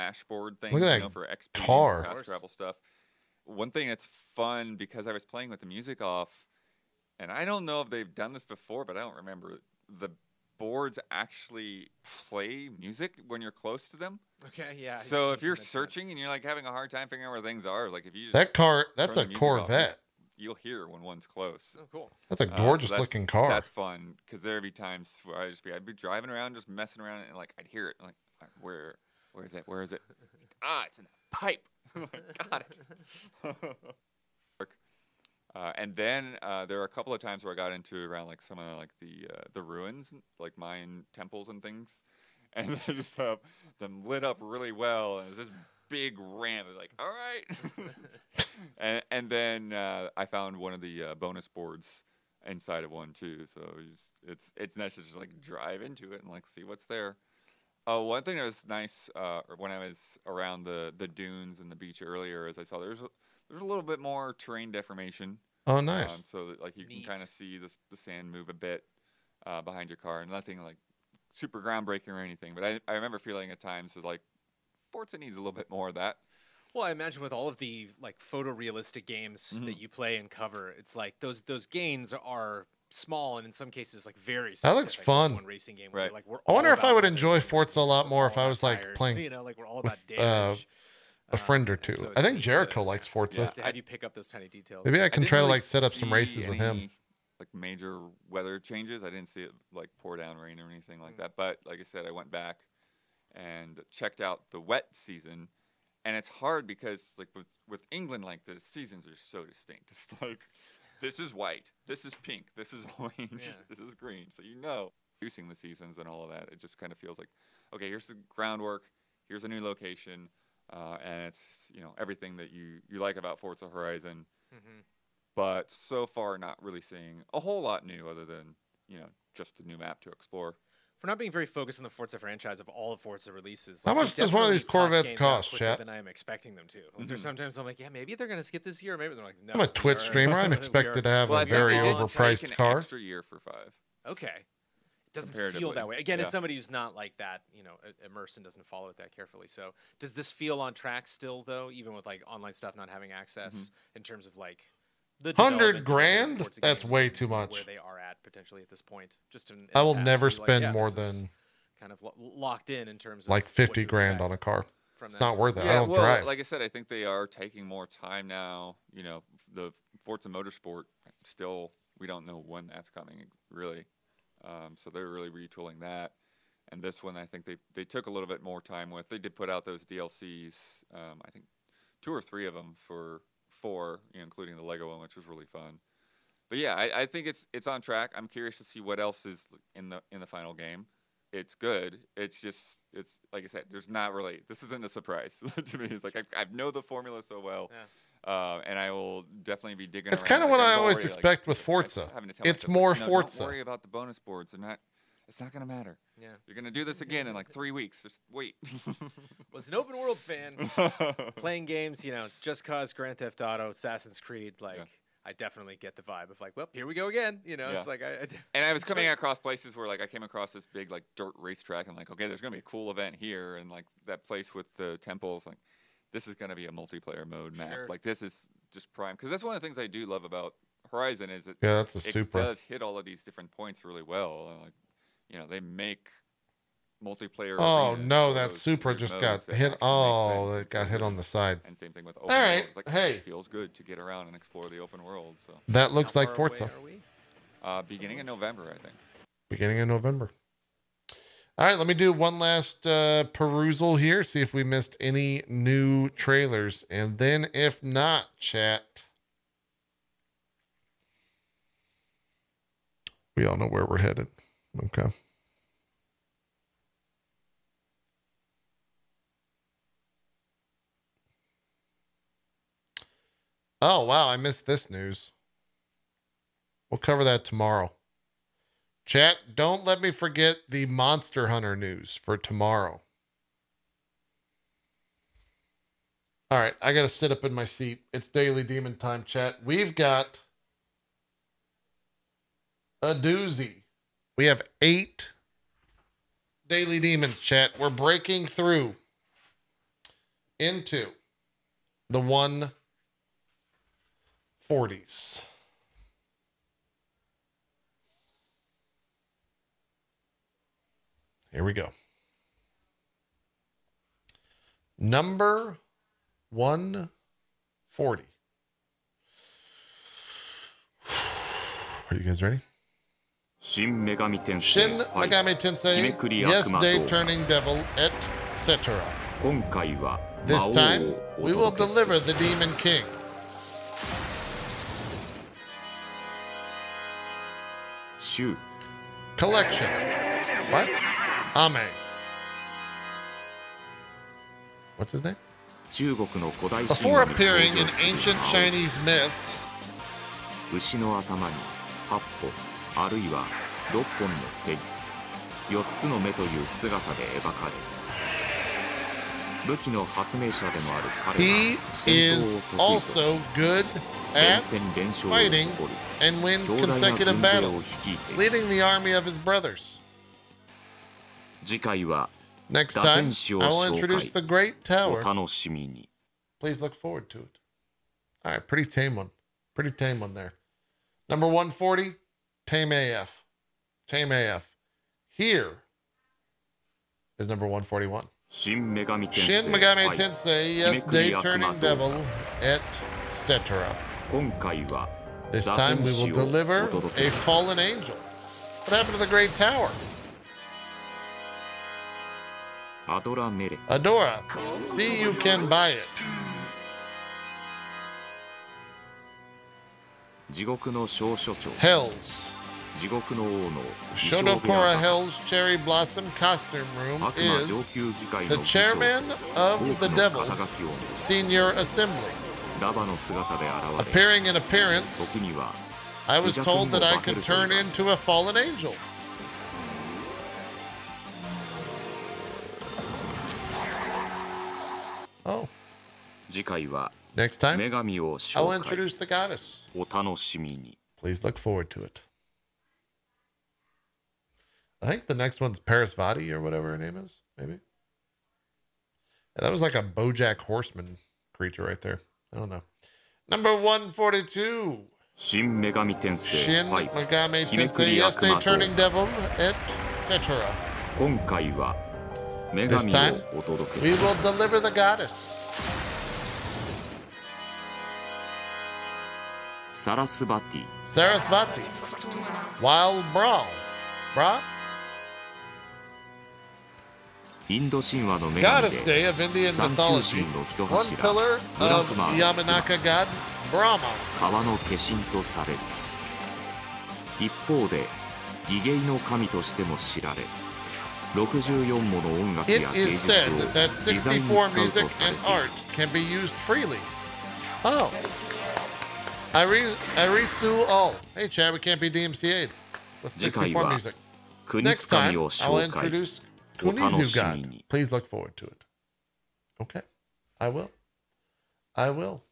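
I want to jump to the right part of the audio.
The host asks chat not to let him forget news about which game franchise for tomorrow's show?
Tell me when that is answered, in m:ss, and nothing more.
4:40.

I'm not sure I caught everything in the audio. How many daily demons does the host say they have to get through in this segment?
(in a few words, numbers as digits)
8.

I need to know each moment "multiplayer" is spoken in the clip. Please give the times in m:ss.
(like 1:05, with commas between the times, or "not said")
3:46, 3:57.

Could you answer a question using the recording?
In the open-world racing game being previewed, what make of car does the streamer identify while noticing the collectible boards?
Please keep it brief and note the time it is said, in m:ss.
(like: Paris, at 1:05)
Corvette, at 0:18.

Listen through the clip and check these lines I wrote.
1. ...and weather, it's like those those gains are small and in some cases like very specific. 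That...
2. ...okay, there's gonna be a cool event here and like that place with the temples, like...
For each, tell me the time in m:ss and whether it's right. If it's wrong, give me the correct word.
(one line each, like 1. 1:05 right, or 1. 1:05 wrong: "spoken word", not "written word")
1. 1:20 wrong: "cover", not "weather"
2. 3:42 right.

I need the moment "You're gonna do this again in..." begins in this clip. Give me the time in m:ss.
3:26.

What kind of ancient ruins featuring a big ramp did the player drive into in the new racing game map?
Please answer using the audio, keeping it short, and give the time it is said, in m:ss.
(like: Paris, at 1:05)
Mayan temples, at 0:40.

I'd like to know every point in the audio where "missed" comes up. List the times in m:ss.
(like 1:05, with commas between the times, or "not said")
4:14, 4:34.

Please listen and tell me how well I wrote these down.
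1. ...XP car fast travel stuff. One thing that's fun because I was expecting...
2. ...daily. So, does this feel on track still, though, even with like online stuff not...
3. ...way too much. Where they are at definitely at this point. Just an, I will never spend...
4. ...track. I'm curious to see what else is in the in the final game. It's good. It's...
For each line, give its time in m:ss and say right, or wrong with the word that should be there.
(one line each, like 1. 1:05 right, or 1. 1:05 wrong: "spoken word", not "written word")
1. 0:01 wrong: "playing", not "expecting"
2. 2:29 wrong: "carefully", not "daily"
3. 2:36 wrong: "potentially", not "definitely"
4. 3:07 right.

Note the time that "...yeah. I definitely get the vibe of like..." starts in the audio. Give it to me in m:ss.
3:34.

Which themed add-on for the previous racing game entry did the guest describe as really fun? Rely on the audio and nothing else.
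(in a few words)
the Lego one.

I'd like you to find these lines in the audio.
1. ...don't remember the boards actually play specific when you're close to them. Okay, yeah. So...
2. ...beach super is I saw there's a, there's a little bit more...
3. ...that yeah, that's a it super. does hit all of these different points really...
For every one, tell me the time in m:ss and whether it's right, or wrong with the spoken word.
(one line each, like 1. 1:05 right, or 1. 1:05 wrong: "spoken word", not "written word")
1. 0:09 wrong: "music", not "specific"
2. 1:01 wrong: "earlier", not "super"
3. 3:51 right.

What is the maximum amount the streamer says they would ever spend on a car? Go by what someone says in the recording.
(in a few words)
fifty grand.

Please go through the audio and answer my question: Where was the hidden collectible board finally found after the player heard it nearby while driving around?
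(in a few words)
in the pipe.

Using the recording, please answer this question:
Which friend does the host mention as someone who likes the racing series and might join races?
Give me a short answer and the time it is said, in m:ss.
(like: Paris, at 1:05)
Jericho, at 1:32.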